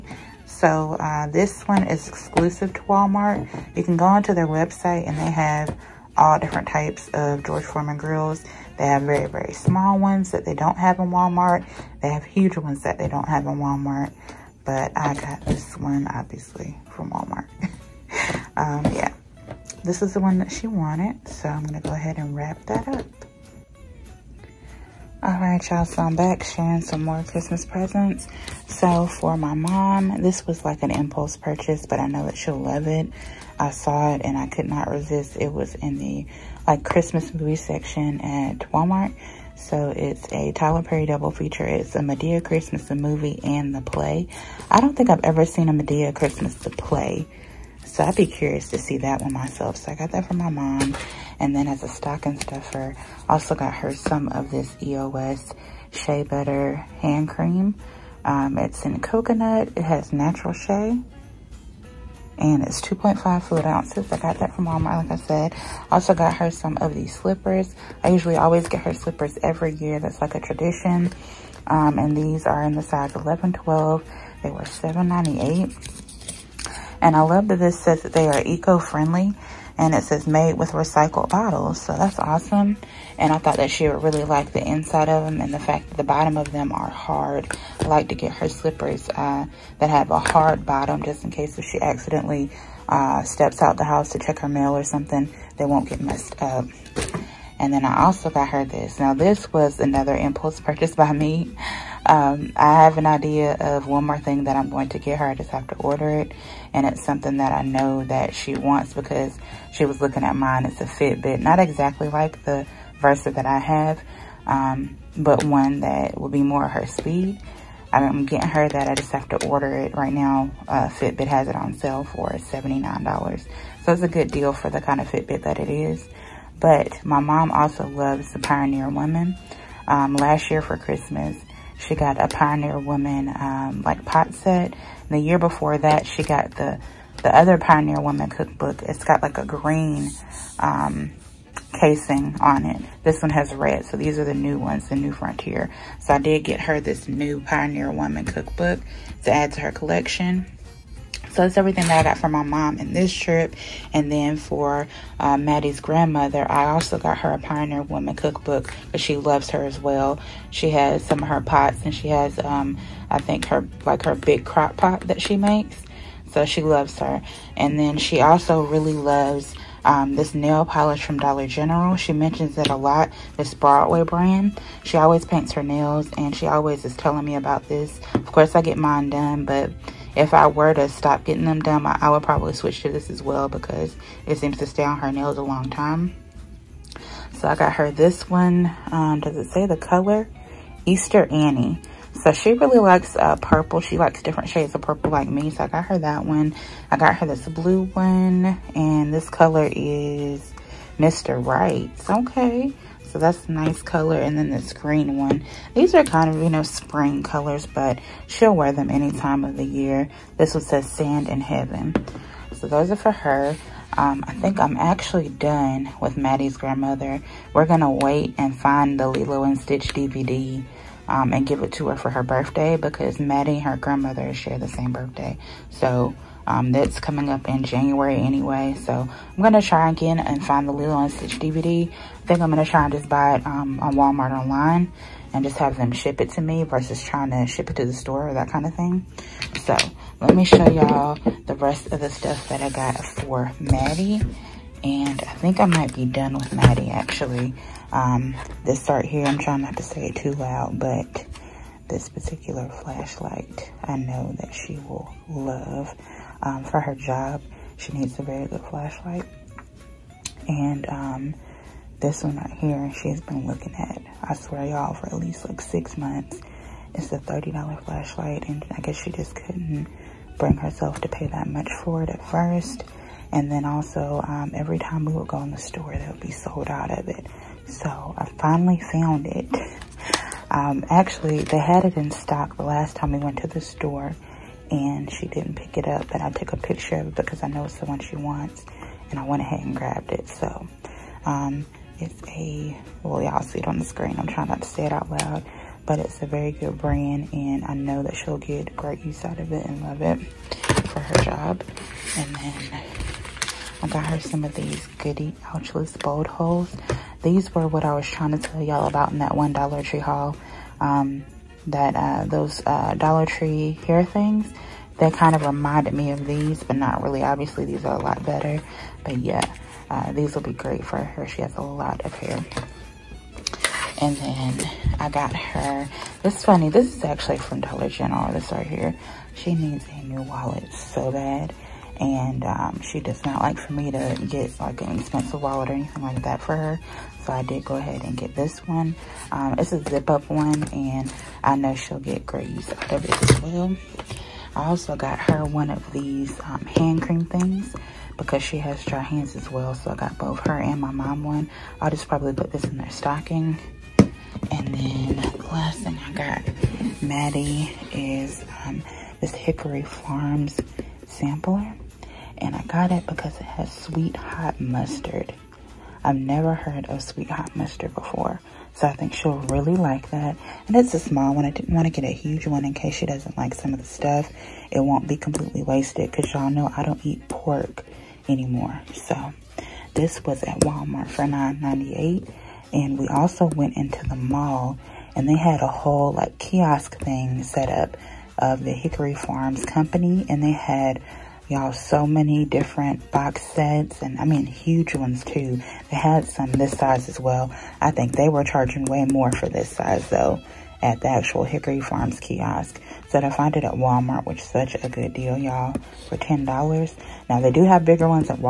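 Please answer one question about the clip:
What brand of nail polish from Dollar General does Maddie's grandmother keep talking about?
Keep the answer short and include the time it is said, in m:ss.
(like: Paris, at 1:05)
Broadway, at 2:53.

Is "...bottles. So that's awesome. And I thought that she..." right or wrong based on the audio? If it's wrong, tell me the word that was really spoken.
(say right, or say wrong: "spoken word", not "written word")
right.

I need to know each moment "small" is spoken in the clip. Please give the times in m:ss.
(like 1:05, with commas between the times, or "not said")
0:09, 6:10.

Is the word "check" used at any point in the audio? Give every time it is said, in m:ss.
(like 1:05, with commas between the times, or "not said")
1:34.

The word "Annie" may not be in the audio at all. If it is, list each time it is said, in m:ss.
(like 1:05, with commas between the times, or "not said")
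3:11.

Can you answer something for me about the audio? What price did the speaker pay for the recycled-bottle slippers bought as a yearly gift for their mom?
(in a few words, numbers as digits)
$7.98.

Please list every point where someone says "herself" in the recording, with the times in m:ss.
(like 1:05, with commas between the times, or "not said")
4:30.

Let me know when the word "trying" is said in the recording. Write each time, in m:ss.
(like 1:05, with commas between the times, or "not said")
3:57, 4:09, 4:54, 5:08.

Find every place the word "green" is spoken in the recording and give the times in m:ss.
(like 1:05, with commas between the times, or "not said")
2:19, 3:24.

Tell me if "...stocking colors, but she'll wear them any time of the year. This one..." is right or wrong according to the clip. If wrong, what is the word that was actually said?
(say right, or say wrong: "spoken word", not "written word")
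wrong: "spring", not "stocking".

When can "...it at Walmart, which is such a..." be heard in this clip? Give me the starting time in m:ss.
6:43.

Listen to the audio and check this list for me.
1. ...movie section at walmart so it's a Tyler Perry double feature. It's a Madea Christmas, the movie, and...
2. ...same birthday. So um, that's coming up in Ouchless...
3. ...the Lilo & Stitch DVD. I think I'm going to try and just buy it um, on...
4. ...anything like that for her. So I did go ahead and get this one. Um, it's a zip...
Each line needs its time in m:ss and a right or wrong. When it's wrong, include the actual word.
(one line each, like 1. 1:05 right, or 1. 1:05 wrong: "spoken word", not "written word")
1. 0:37 right
2. 3:44 wrong: "January", not "Ouchless"
3. 3:50 right
4. 5:35 right.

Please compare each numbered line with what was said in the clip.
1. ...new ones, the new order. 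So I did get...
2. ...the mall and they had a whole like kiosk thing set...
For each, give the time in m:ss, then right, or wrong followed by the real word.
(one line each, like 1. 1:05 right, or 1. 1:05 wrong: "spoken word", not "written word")
1. 2:24 wrong: "frontier", not "order"
2. 6:24 right.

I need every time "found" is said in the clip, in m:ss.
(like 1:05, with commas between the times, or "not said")
4:38.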